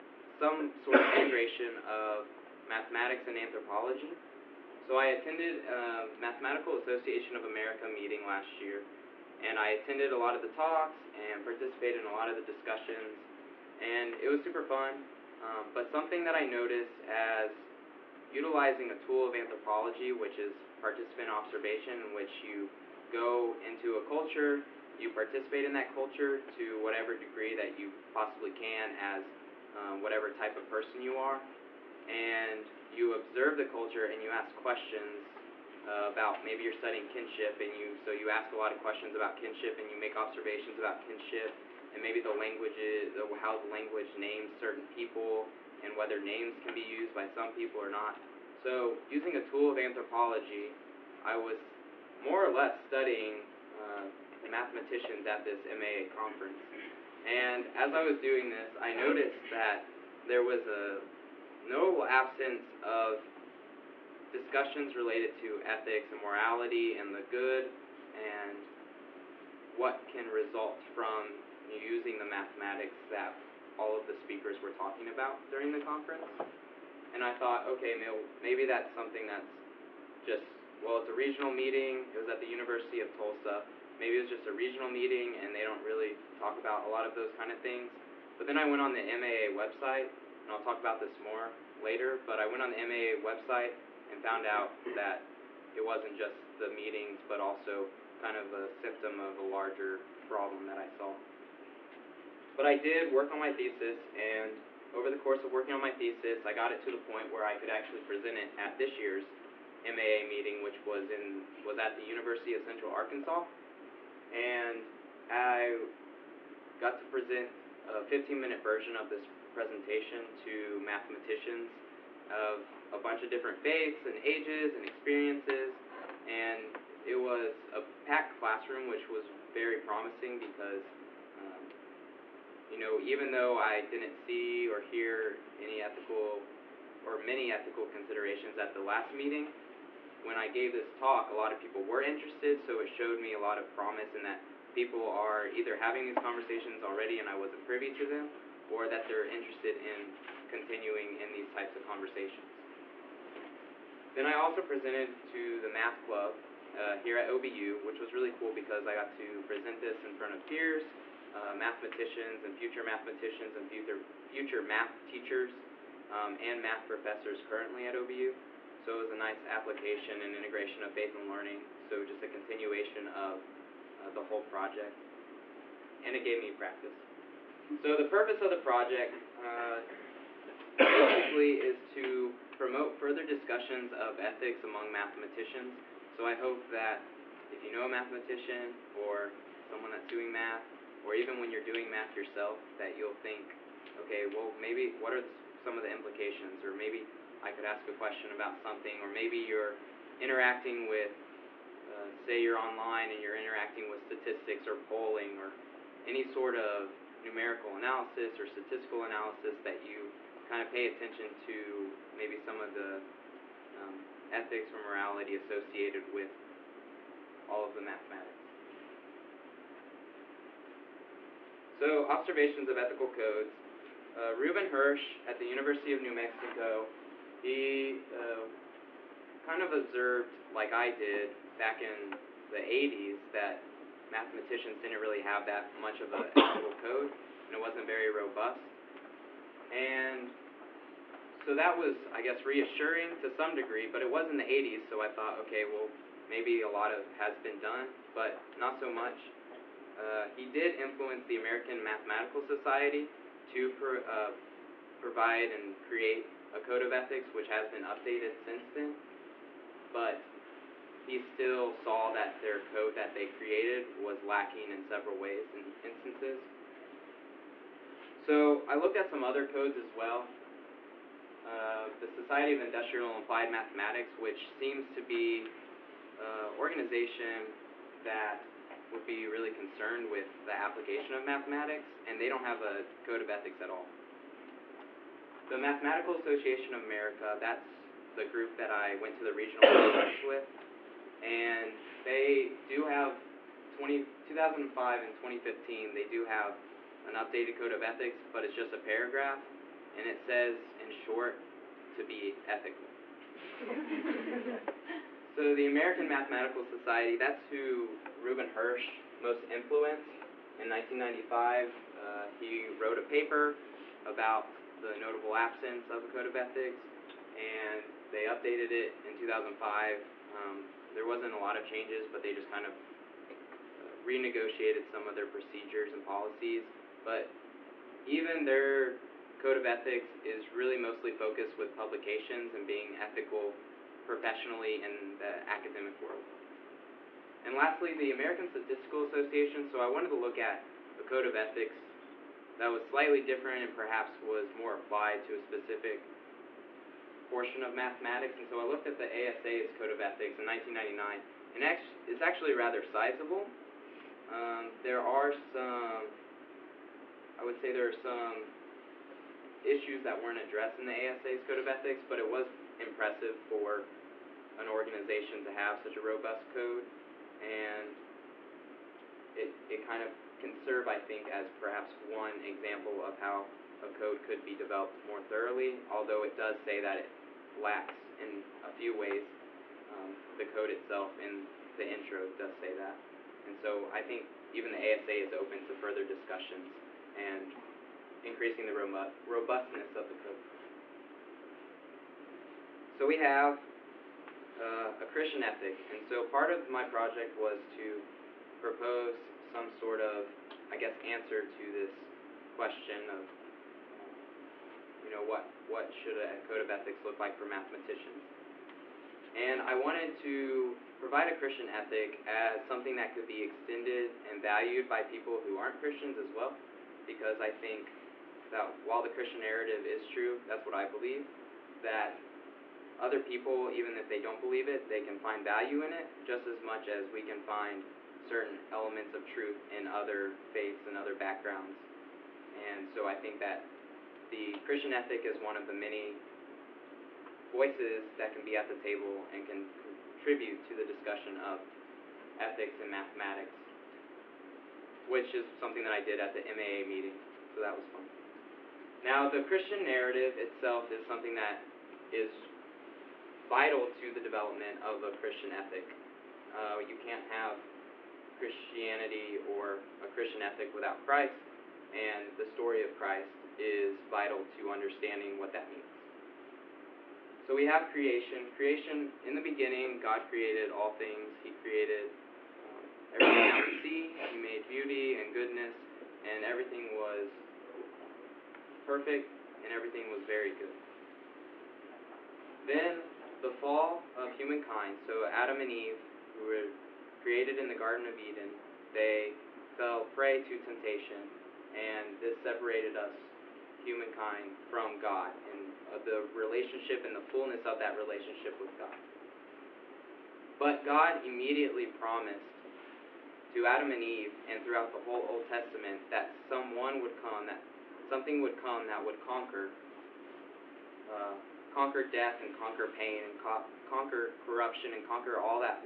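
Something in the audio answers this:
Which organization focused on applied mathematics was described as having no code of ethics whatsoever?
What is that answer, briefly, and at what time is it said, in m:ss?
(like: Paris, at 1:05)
Society of Industrial and Applied Mathematics, at 4:32.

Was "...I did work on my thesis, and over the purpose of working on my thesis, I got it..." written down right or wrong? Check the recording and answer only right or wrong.
wrong.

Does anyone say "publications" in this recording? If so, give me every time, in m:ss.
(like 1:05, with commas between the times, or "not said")
5:31.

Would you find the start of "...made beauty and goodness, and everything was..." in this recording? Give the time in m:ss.
7:54.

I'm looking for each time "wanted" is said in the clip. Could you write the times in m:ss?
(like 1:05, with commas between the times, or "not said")
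5:39, 6:49.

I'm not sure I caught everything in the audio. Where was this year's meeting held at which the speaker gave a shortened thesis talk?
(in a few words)
University of Central Arkansas.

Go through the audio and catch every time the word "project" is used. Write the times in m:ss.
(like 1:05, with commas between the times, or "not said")
2:54, 2:58, 6:36.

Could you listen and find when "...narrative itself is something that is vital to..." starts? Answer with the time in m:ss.
7:29.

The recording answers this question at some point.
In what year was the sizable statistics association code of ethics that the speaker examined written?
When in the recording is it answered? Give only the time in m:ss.
5:50.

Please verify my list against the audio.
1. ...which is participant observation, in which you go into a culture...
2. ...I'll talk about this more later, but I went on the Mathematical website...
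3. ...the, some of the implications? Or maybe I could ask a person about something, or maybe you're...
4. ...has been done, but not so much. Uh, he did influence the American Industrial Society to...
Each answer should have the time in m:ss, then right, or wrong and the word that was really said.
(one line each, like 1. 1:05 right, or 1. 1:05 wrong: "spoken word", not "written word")
1. 0:20 right
2. 1:30 wrong: "MAA", not "Mathematical"
3. 3:15 wrong: "question", not "person"
4. 4:07 wrong: "Mathematical", not "Industrial".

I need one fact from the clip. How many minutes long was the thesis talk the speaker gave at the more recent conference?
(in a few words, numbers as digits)
15.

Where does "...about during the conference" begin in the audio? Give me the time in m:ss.
1:15.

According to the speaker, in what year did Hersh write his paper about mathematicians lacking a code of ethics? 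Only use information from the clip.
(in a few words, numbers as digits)
1995.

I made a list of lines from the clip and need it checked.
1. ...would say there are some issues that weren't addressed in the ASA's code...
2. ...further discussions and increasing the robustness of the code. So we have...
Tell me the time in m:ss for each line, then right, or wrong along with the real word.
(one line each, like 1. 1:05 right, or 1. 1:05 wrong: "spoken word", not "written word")
1. 5:57 right
2. 6:25 right.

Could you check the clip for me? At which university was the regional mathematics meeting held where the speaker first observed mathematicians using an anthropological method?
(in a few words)
University of Tulsa.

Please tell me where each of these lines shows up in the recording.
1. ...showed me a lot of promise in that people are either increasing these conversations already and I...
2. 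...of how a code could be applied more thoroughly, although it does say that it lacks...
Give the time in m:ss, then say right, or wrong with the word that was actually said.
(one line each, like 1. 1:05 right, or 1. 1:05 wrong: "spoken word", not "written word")
1. 2:22 wrong: "having", not "increasing"
2. 6:13 wrong: "developed", not "applied".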